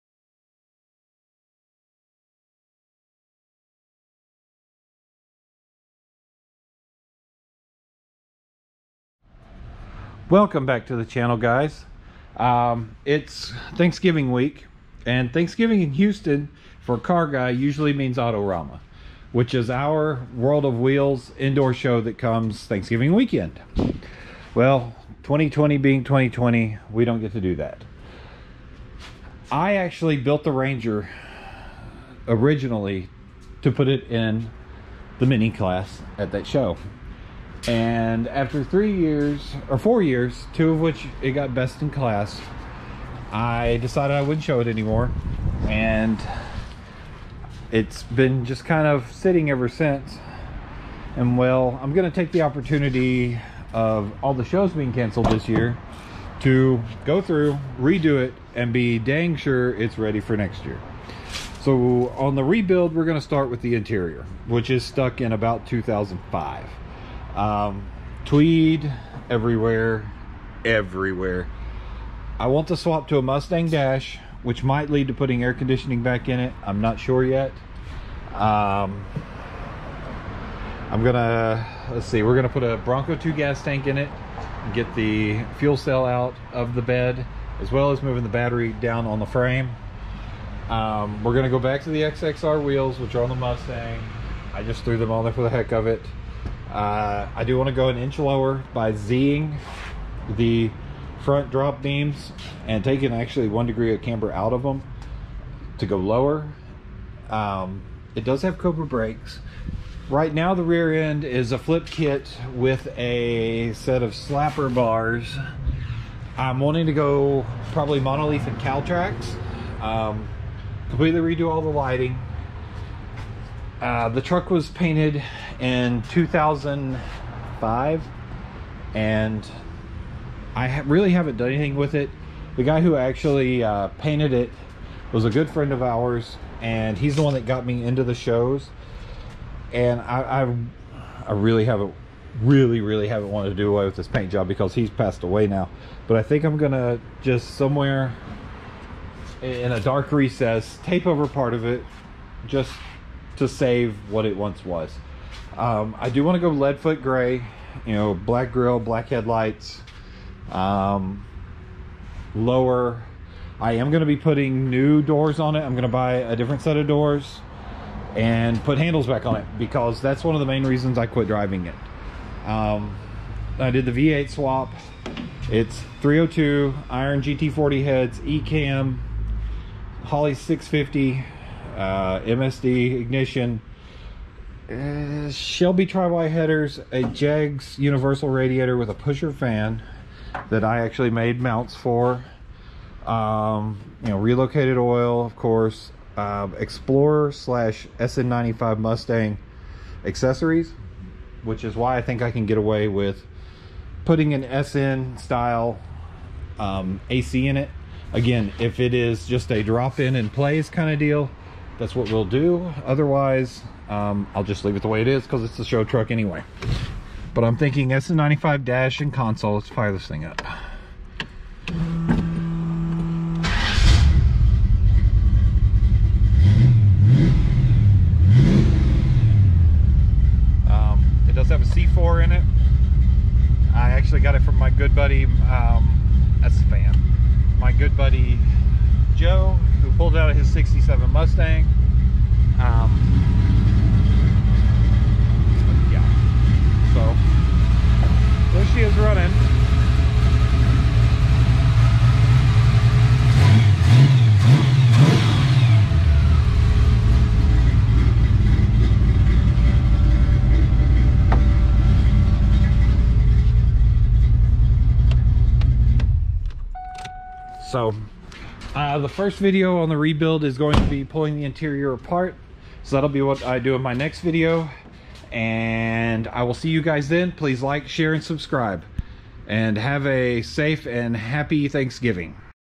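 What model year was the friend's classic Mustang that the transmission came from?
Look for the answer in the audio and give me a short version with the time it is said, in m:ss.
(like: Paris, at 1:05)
1967, at 4:00.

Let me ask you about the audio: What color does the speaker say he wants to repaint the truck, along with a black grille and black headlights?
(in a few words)
Leadfoot Gray.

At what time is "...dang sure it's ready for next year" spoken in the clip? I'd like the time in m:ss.
0:58.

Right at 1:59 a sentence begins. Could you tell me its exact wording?
Um, completely redo all the lighting uh, the truck was painted in 2005 and I ha really haven't done anything with it.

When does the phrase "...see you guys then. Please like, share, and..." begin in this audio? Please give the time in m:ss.
4:36.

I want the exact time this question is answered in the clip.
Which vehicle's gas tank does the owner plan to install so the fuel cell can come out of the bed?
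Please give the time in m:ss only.
1:22.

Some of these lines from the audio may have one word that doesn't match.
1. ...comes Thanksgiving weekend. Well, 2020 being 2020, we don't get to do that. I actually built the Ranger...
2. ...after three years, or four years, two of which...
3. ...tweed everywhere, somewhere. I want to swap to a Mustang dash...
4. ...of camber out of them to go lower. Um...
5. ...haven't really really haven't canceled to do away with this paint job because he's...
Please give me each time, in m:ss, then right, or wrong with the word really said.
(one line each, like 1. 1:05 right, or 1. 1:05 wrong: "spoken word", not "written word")
1. 0:22 right
2. 0:38 right
3. 1:08 wrong: "everywhere", not "somewhere"
4. 1:43 right
5. 2:21 wrong: "wanted", not "canceled".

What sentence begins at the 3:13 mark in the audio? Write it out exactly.
Um, you know, relocated oil, of course.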